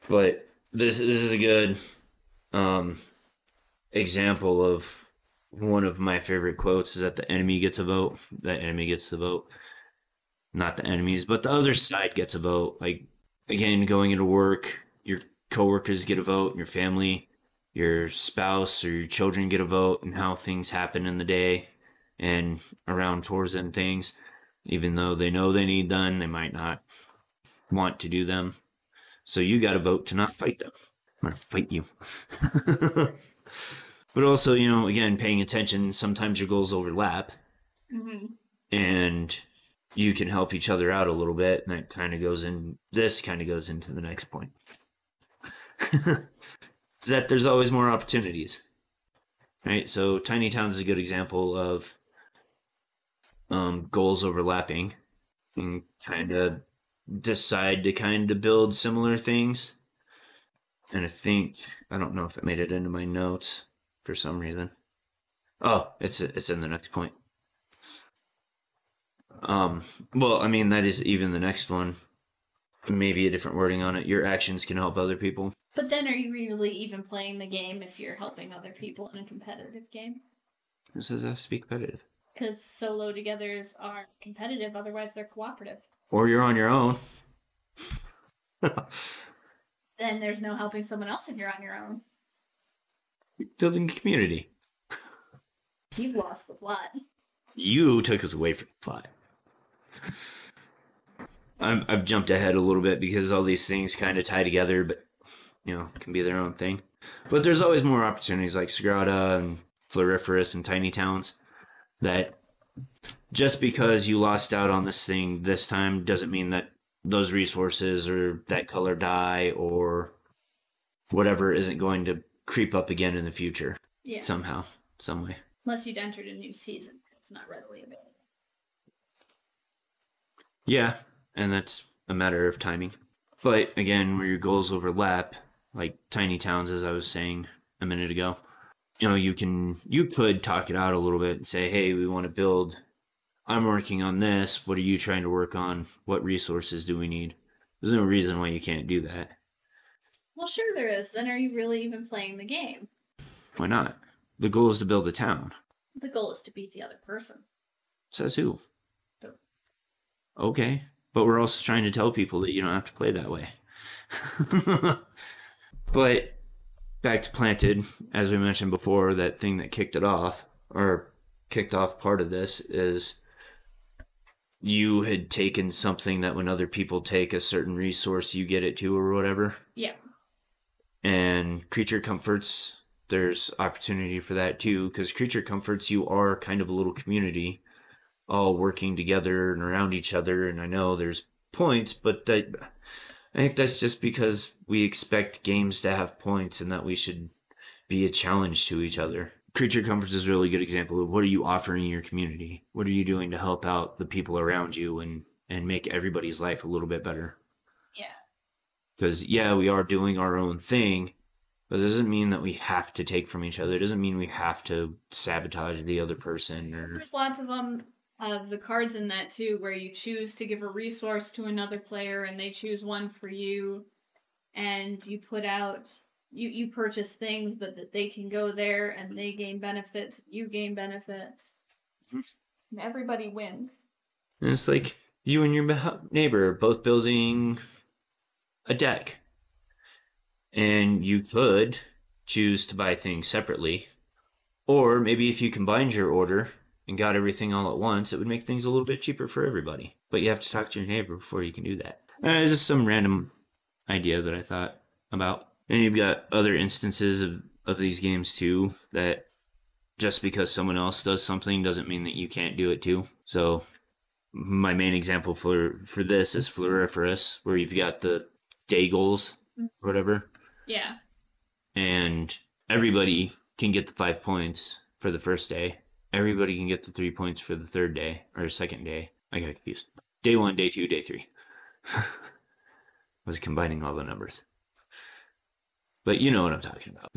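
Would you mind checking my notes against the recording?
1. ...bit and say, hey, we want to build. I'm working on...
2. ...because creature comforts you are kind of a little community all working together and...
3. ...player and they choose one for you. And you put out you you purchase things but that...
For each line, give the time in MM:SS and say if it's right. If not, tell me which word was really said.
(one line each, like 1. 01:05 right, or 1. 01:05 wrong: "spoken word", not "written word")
1. 02:21 right
2. 03:04 right
3. 03:41 right.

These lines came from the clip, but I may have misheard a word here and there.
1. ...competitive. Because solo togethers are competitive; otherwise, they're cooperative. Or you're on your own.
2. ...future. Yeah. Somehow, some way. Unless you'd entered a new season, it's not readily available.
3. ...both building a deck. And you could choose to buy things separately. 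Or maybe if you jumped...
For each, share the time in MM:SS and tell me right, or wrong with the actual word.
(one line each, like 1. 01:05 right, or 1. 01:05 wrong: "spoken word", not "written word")
1. 01:21 right
2. 02:03 right
3. 03:56 wrong: "combined", not "jumped".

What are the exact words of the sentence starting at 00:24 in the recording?
Even though they know they need done, they might not want to do them.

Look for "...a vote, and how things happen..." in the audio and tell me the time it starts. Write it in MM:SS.
00:19.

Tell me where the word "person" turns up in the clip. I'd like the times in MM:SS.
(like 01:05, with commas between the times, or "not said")
02:37, 03:36.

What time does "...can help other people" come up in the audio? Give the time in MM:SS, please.
01:14.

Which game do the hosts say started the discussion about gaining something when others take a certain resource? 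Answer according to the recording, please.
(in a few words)
Planted.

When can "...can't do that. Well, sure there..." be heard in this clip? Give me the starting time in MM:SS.
02:28.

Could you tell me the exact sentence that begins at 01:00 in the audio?
And I think, I don't know if it made it into my notes for some reason.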